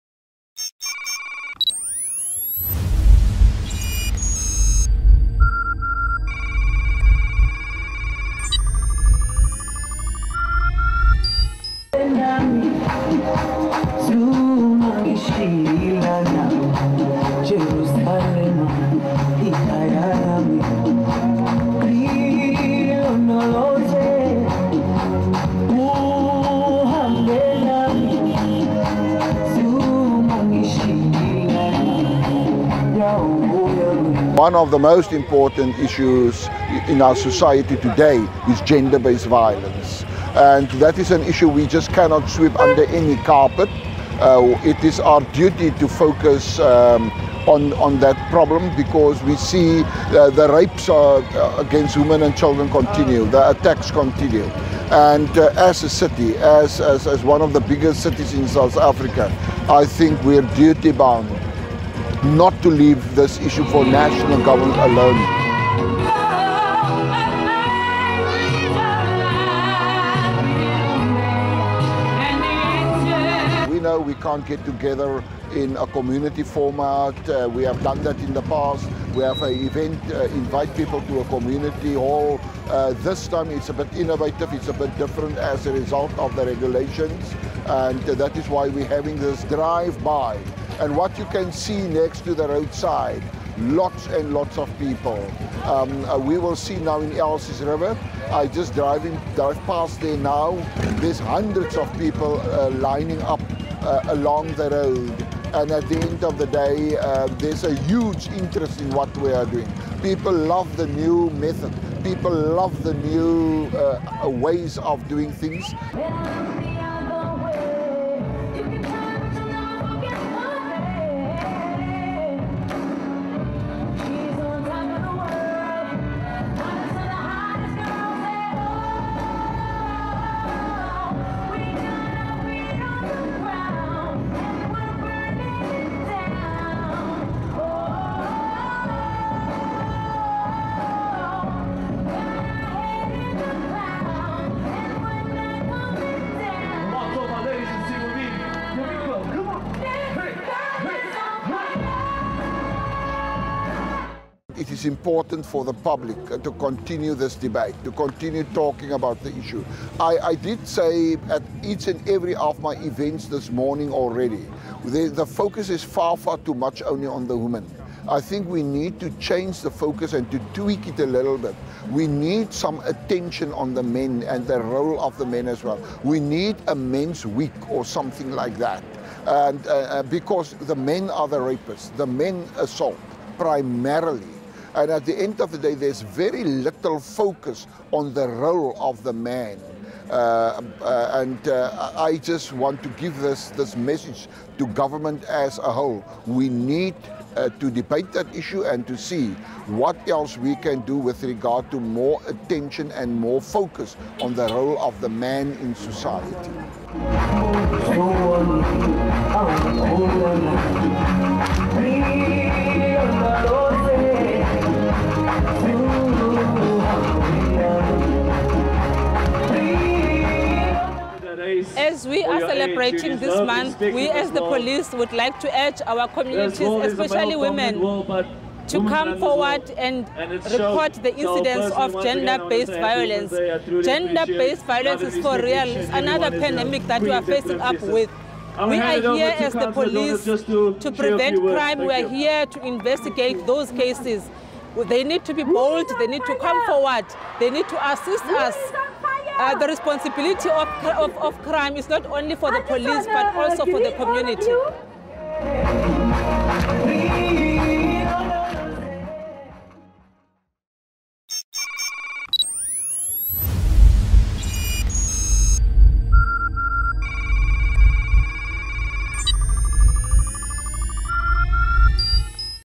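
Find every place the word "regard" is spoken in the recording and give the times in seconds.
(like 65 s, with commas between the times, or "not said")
201 s.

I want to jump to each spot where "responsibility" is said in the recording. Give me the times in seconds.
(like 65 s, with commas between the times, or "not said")
249 s.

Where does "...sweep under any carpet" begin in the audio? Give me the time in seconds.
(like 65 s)
42 s.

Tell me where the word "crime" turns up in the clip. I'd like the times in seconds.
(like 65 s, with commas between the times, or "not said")
241 s, 251 s.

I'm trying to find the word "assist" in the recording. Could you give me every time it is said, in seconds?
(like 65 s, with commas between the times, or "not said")
247 s.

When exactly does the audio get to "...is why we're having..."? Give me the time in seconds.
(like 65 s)
88 s.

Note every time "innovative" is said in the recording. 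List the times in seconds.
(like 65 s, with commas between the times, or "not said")
83 s.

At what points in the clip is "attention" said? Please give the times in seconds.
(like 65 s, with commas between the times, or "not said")
172 s, 202 s.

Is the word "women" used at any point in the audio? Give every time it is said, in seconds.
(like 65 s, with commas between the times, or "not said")
51 s, 167 s, 227 s.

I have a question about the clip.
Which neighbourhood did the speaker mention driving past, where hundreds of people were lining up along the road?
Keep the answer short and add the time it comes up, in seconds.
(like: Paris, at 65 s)
Elsies River, at 97 s.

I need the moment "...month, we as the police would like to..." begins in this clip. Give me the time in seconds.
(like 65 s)
223 s.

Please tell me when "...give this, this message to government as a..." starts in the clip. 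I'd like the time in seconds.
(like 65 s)
192 s.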